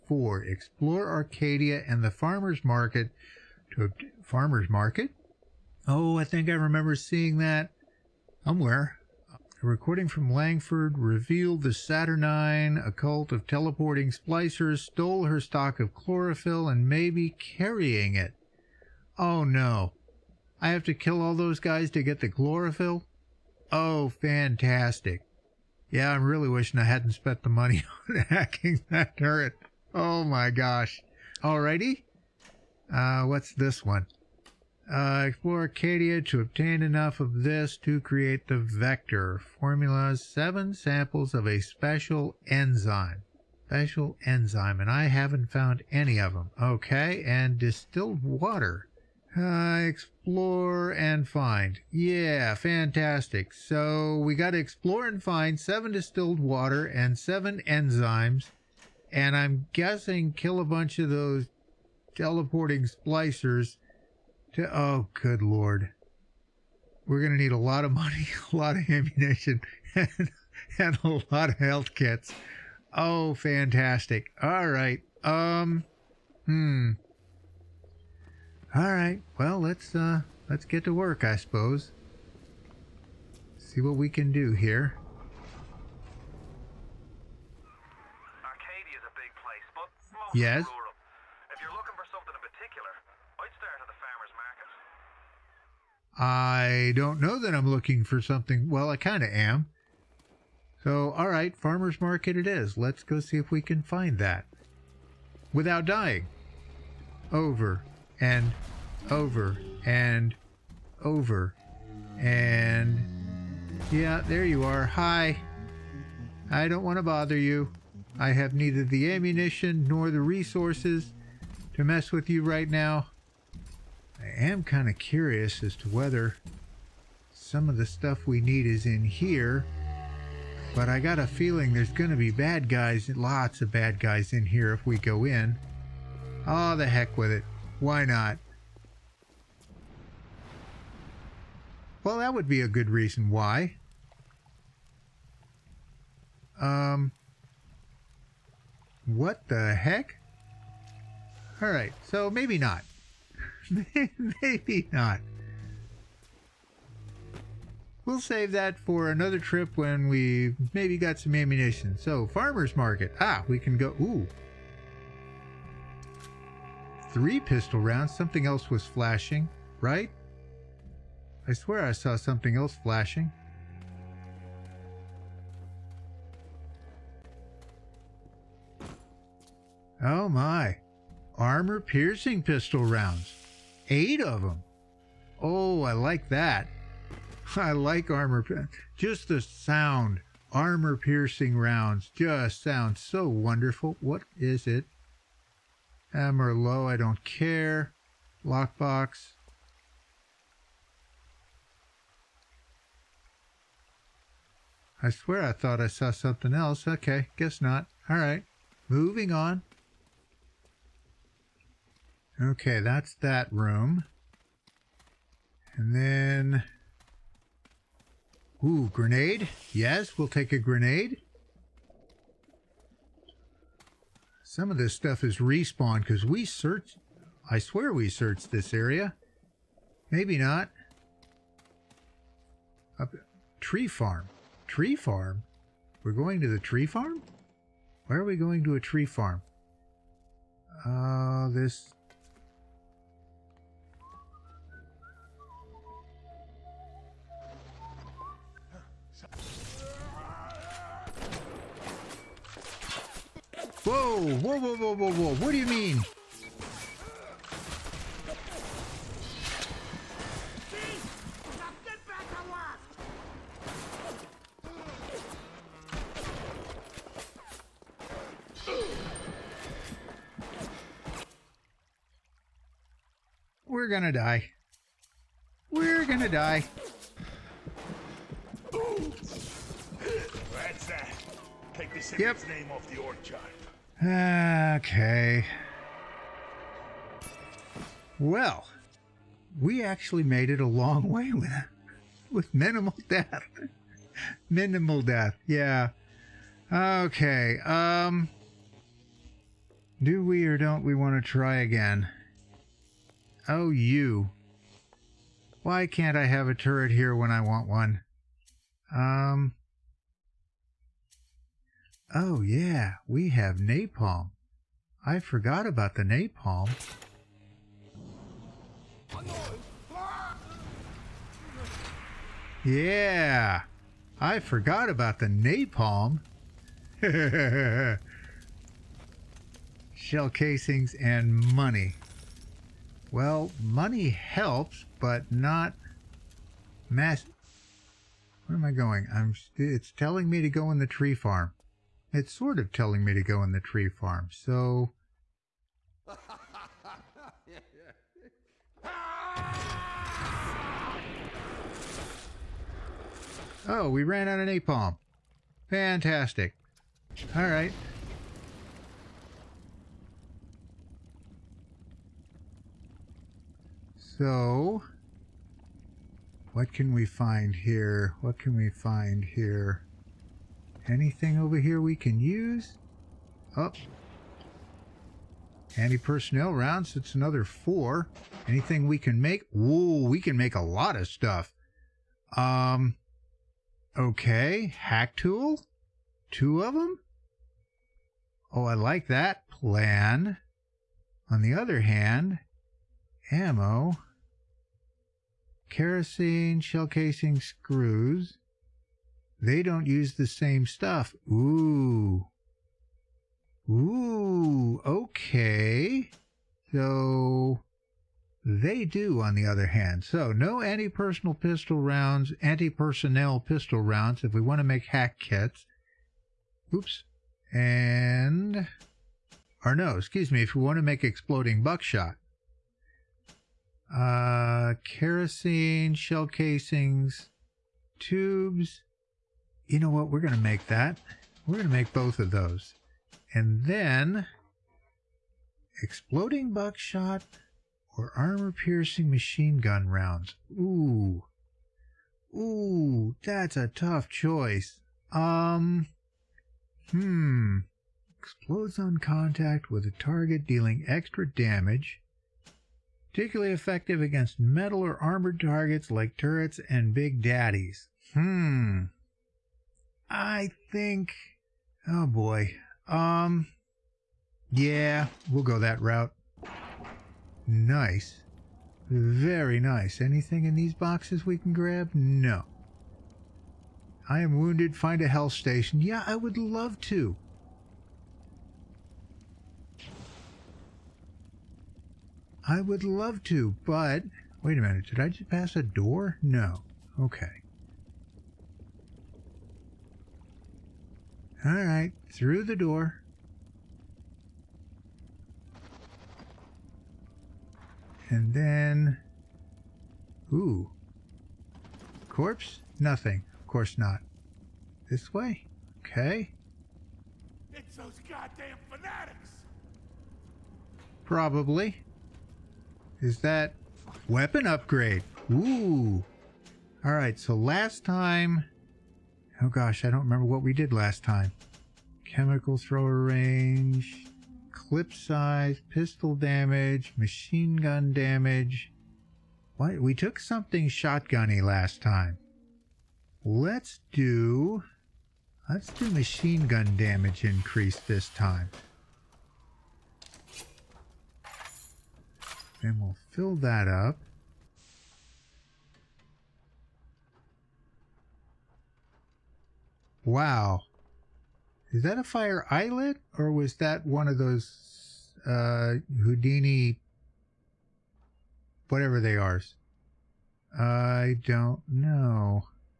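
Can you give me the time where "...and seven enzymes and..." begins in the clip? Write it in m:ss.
0:56.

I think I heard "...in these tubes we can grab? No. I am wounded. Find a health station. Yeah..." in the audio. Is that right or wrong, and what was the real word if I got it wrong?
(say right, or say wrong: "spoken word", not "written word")
wrong: "boxes", not "tubes".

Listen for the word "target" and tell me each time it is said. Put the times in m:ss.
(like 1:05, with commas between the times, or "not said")
7:29, 7:35.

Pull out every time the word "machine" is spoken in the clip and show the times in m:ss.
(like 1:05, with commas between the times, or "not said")
7:19, 8:46, 8:55.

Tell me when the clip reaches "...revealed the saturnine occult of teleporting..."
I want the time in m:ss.
0:10.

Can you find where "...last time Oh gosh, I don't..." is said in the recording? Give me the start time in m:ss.
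8:37.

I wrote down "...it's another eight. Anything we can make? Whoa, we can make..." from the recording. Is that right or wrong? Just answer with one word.
wrong.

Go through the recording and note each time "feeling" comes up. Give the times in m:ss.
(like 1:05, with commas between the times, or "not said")
2:11.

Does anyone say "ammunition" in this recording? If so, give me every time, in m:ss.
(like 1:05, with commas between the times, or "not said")
1:08, 1:59, 2:41.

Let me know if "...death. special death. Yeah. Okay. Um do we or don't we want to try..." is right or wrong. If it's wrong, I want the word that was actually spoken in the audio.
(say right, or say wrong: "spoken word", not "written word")
wrong: "minimal", not "special".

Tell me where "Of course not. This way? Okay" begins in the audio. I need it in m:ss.
8:23.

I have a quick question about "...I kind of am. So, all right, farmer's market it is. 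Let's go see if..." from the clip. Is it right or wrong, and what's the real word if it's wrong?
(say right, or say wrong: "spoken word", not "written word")
right.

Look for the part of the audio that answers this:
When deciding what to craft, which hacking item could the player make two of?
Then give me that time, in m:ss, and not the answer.
6:24.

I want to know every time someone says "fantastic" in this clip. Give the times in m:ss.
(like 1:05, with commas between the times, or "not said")
0:24, 0:52, 1:13, 5:55.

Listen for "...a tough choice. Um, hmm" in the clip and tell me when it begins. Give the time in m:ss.
7:23.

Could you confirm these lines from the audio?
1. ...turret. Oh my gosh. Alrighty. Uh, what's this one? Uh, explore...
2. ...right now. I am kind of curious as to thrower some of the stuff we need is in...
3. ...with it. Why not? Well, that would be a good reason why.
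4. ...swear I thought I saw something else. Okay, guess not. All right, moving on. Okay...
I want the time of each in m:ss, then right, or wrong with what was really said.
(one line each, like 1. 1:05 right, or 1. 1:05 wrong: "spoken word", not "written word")
1. 0:29 right
2. 2:02 wrong: "whether", not "thrower"
3. 2:17 right
4. 3:25 right.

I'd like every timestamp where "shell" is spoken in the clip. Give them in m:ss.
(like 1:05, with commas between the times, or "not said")
5:29, 6:36, 7:05.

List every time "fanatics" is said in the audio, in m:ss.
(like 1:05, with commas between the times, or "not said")
8:28.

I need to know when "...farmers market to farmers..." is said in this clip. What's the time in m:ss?
0:02.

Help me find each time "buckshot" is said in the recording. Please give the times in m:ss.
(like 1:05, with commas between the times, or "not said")
7:01, 7:16.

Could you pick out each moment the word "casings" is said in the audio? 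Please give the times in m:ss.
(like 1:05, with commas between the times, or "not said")
5:30, 6:36, 7:06.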